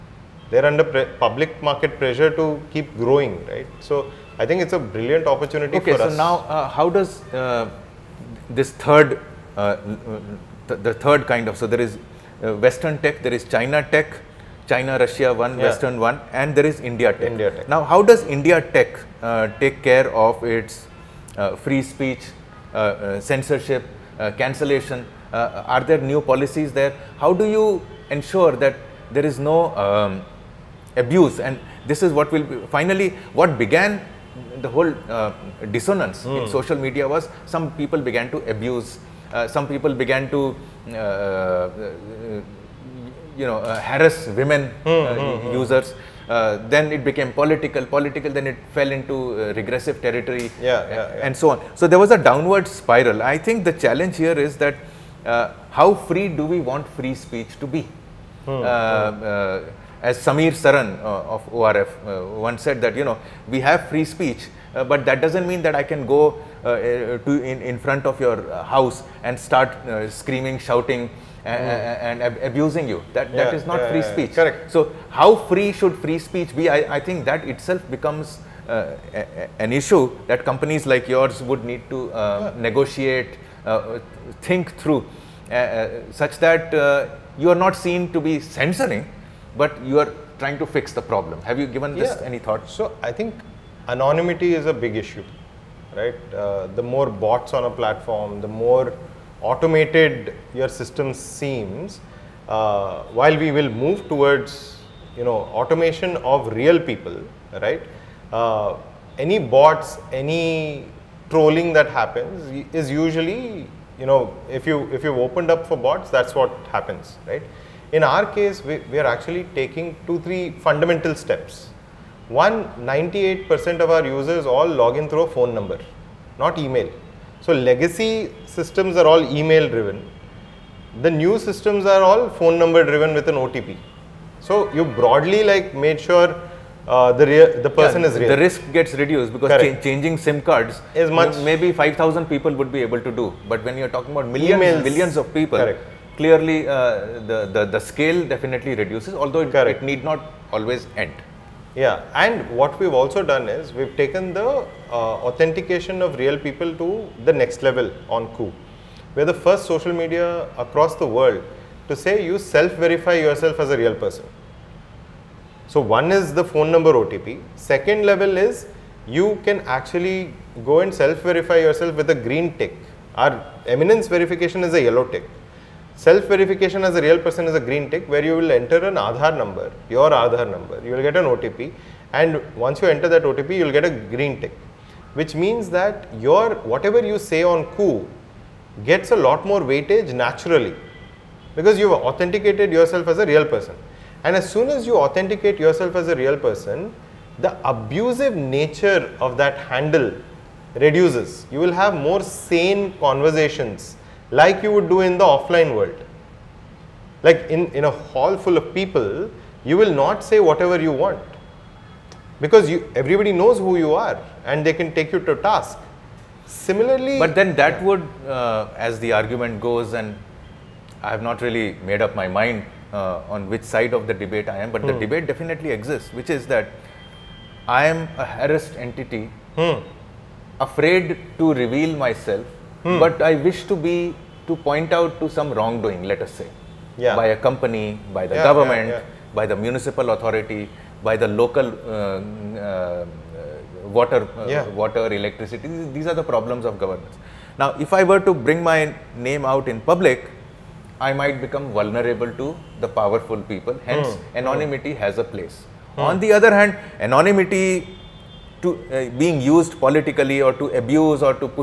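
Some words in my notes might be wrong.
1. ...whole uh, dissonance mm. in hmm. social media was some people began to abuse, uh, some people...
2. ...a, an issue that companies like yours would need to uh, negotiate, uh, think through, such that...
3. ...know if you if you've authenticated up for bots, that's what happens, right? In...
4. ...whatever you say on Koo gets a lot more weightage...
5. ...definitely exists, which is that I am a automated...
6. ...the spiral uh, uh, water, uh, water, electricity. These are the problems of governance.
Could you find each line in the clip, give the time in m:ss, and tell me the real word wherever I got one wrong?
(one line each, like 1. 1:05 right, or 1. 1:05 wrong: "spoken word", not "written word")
1. 0:34 right
2. 1:19 right
3. 1:54 wrong: "opened", not "authenticated"
4. 3:06 right
5. 3:45 wrong: "harassed", not "automated"
6. 4:01 wrong: "local", not "spiral".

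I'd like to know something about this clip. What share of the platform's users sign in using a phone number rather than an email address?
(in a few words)
98%.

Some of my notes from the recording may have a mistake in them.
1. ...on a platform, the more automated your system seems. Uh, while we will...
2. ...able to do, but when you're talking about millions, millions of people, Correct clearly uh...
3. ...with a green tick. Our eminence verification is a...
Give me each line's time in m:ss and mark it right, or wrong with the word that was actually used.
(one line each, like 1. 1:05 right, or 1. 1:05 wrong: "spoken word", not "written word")
1. 1:37 right
2. 2:22 right
3. 2:51 right.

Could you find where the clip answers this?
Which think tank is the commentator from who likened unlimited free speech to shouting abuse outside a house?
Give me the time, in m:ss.
1:01.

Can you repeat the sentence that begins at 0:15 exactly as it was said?
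Western one, and there is India tech.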